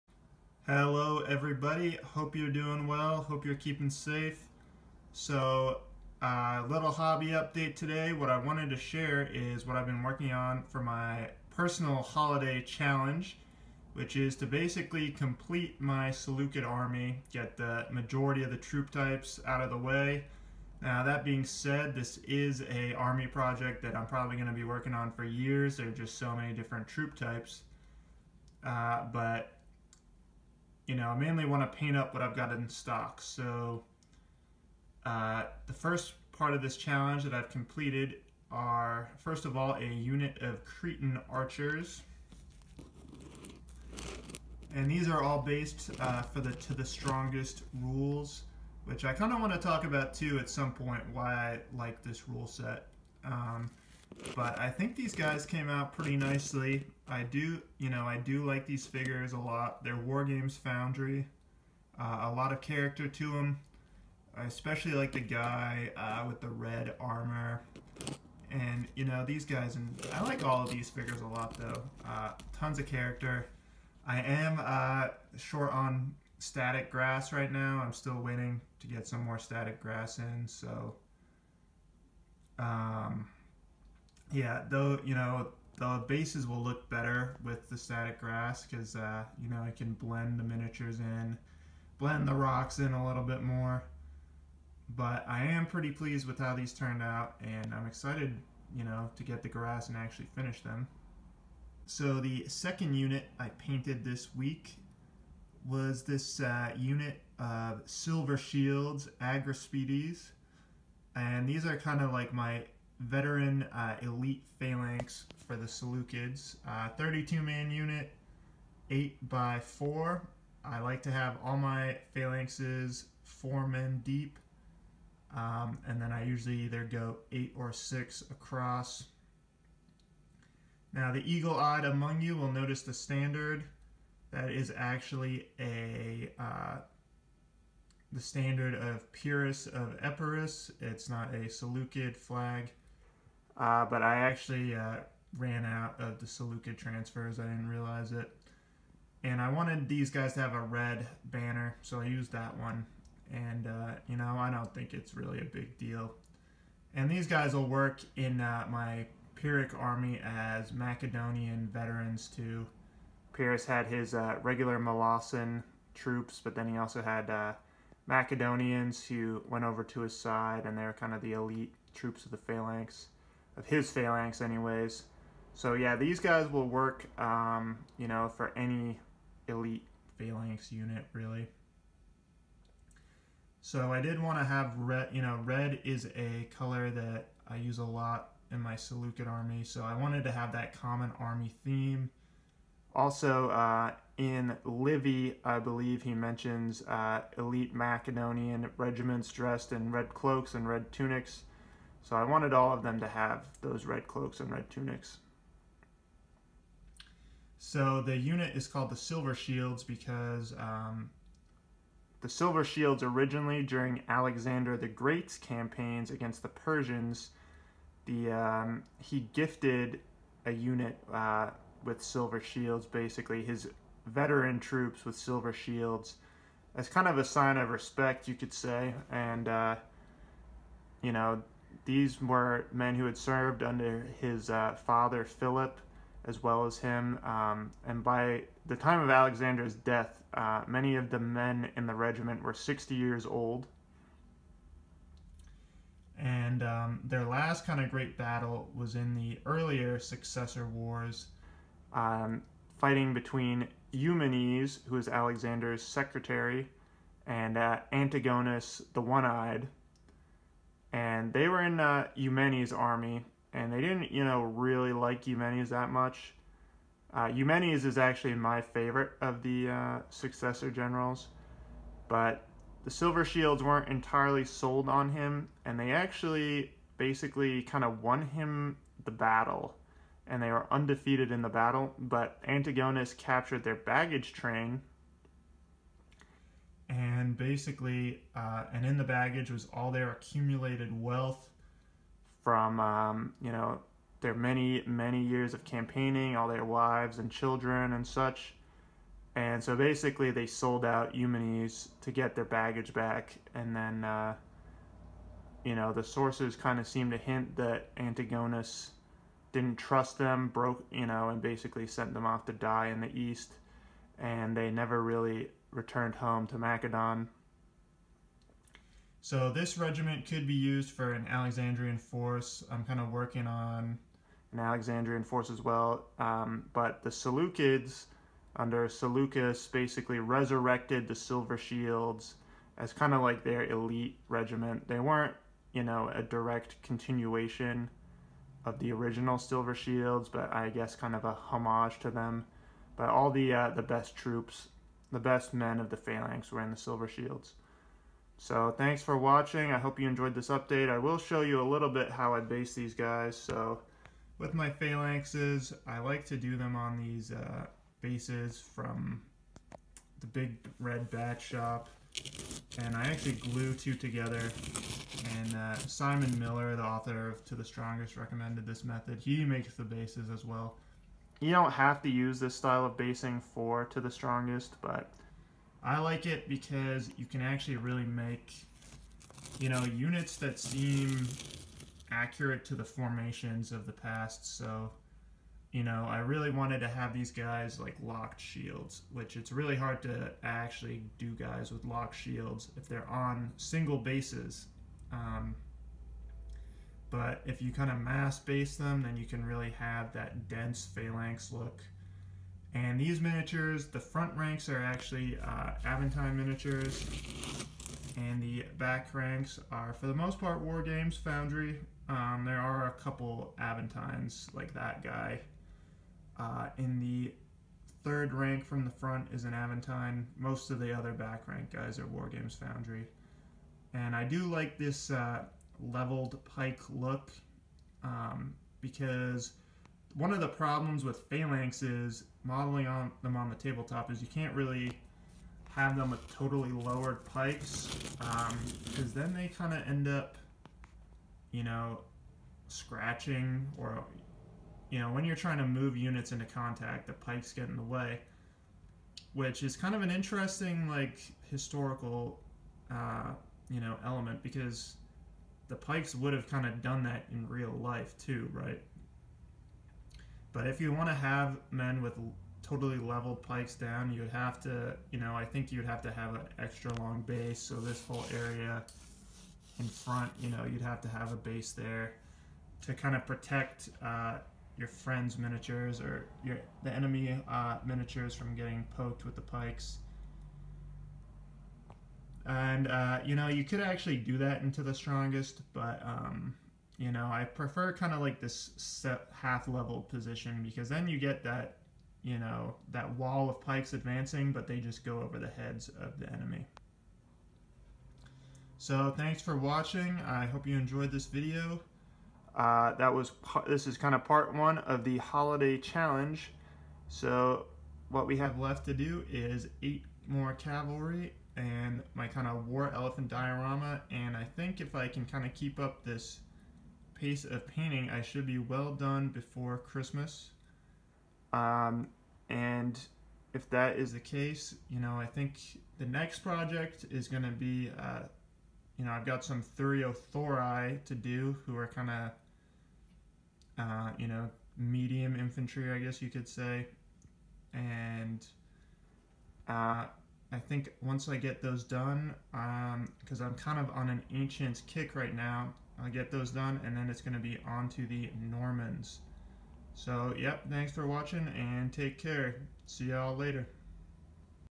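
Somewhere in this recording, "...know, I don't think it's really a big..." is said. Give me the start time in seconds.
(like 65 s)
154 s.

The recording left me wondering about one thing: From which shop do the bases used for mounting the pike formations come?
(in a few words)
Big Red Bat shop.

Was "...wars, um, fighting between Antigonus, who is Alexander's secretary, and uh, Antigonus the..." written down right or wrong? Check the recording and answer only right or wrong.
wrong.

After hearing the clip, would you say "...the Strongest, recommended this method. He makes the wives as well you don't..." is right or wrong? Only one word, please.
wrong.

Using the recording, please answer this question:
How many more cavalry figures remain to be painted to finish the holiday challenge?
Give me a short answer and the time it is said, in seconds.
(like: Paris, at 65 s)
8, at 509 s.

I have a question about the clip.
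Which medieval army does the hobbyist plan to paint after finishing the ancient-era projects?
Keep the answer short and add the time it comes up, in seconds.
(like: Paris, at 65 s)
The Normans, at 548 s.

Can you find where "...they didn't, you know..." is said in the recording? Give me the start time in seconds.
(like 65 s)
263 s.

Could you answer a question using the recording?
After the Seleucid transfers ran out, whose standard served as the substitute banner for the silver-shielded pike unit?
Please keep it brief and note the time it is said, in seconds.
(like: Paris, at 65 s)
Pyrrhus of Epirus, at 139 s.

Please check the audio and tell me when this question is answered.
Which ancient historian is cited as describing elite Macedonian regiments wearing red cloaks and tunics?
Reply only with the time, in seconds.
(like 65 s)
194 s.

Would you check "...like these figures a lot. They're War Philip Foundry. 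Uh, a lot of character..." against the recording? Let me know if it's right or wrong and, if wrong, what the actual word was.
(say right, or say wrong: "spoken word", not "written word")
wrong: "Games", not "Philip".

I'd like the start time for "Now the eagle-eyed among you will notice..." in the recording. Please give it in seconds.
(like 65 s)
130 s.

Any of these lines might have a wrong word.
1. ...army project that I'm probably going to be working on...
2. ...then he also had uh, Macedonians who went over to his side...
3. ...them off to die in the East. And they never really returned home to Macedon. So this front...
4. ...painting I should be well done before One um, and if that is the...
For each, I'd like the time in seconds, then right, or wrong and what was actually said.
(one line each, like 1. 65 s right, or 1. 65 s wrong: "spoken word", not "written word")
1. 22 s right
2. 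166 s right
3. 312 s wrong: "regiment", not "front"
4. 517 s wrong: "Christmas", not "One".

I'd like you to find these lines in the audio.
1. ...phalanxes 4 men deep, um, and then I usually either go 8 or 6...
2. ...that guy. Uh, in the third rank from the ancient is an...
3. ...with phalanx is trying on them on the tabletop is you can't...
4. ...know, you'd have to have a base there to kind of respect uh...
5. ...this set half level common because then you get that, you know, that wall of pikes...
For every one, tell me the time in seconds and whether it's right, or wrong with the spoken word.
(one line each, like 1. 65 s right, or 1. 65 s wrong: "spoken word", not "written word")
1. 122 s right
2. 414 s wrong: "front", not "ancient"
3. 431 s wrong: "modeling", not "trying"
4. 470 s wrong: "protect", not "respect"
5. 488 s wrong: "position", not "common".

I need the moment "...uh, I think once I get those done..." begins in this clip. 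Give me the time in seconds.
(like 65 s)
539 s.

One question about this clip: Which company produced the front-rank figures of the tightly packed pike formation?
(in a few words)
Aventine Miniatures.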